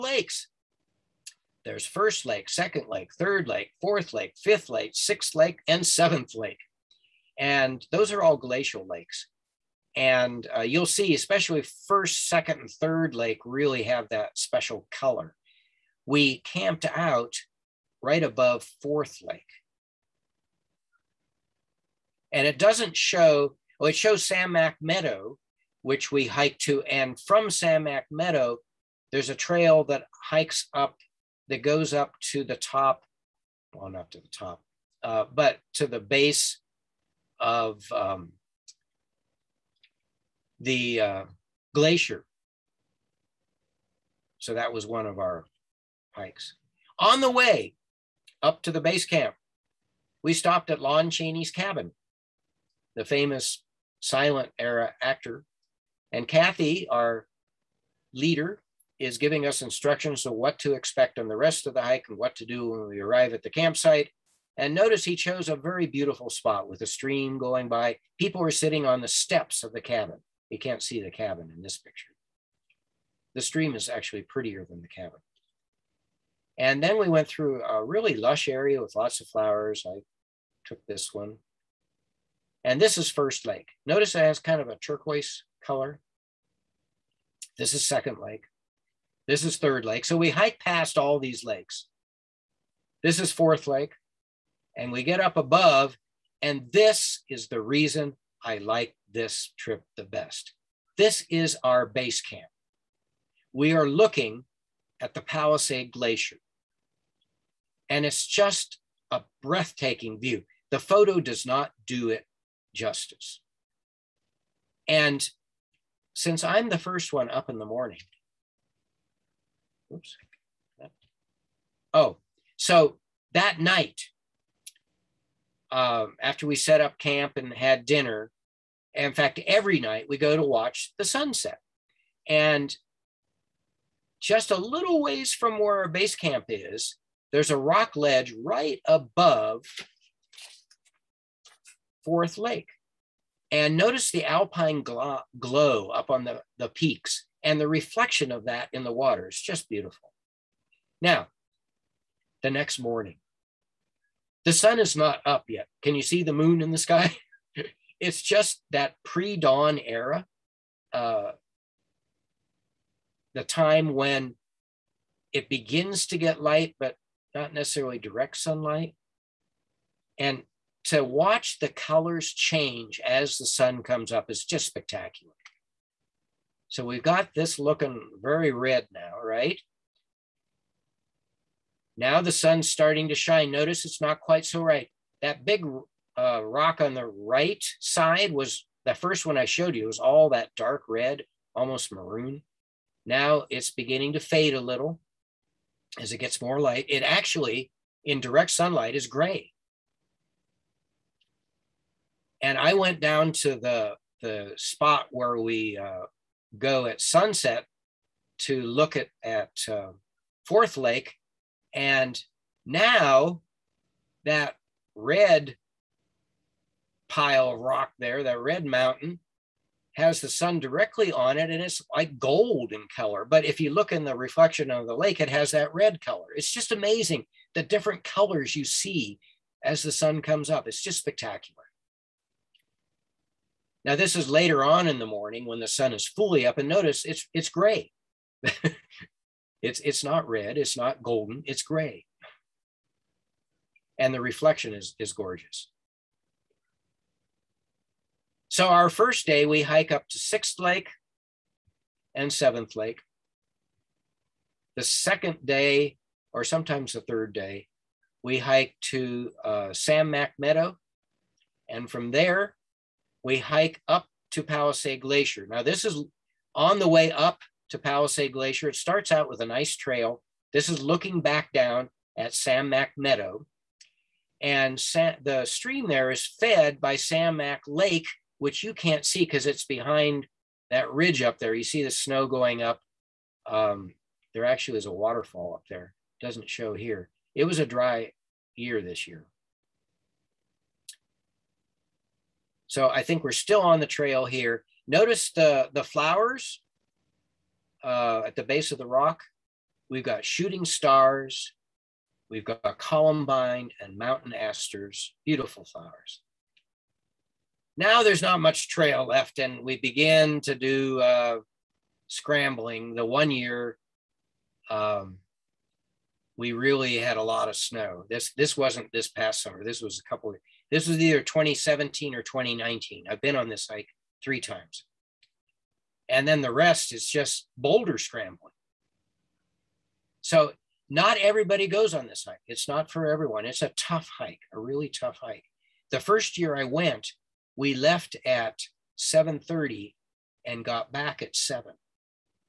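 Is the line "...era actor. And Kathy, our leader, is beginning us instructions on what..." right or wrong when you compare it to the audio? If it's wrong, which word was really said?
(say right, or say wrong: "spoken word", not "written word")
wrong: "giving", not "beginning".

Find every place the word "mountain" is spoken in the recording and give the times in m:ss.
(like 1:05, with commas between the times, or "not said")
3:38, 5:03.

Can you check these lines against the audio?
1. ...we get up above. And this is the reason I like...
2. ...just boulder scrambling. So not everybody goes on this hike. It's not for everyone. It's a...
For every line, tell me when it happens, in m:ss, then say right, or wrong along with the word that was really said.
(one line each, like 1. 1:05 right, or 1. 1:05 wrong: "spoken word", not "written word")
1. 1:34 right
2. 5:27 right.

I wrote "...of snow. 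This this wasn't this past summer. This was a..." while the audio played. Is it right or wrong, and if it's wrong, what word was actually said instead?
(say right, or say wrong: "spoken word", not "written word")
right.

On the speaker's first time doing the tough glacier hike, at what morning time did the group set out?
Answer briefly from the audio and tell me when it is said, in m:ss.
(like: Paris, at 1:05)
7:30, at 5:38.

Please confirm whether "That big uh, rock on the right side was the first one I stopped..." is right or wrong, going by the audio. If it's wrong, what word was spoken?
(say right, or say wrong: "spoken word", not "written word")
wrong: "showed", not "stopped".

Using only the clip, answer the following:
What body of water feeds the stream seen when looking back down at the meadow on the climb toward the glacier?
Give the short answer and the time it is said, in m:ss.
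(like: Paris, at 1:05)
Sam Mack Lake, at 4:36.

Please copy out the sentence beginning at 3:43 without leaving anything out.
But if you look in the reflection of the lake, it has that red color.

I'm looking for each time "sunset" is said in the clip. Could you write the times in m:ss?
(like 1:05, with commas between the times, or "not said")
2:11, 3:27.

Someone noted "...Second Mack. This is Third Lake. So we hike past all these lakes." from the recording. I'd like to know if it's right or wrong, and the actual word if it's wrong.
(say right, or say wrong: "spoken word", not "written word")
wrong: "Lake", not "Mack".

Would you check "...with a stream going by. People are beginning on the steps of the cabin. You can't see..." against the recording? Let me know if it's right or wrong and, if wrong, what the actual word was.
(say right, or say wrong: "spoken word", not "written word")
wrong: "sitting", not "beginning".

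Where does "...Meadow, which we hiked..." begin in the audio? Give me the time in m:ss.
0:24.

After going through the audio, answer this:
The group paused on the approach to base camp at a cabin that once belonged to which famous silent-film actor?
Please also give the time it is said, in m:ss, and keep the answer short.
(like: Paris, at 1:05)
Lon Chaney, at 0:50.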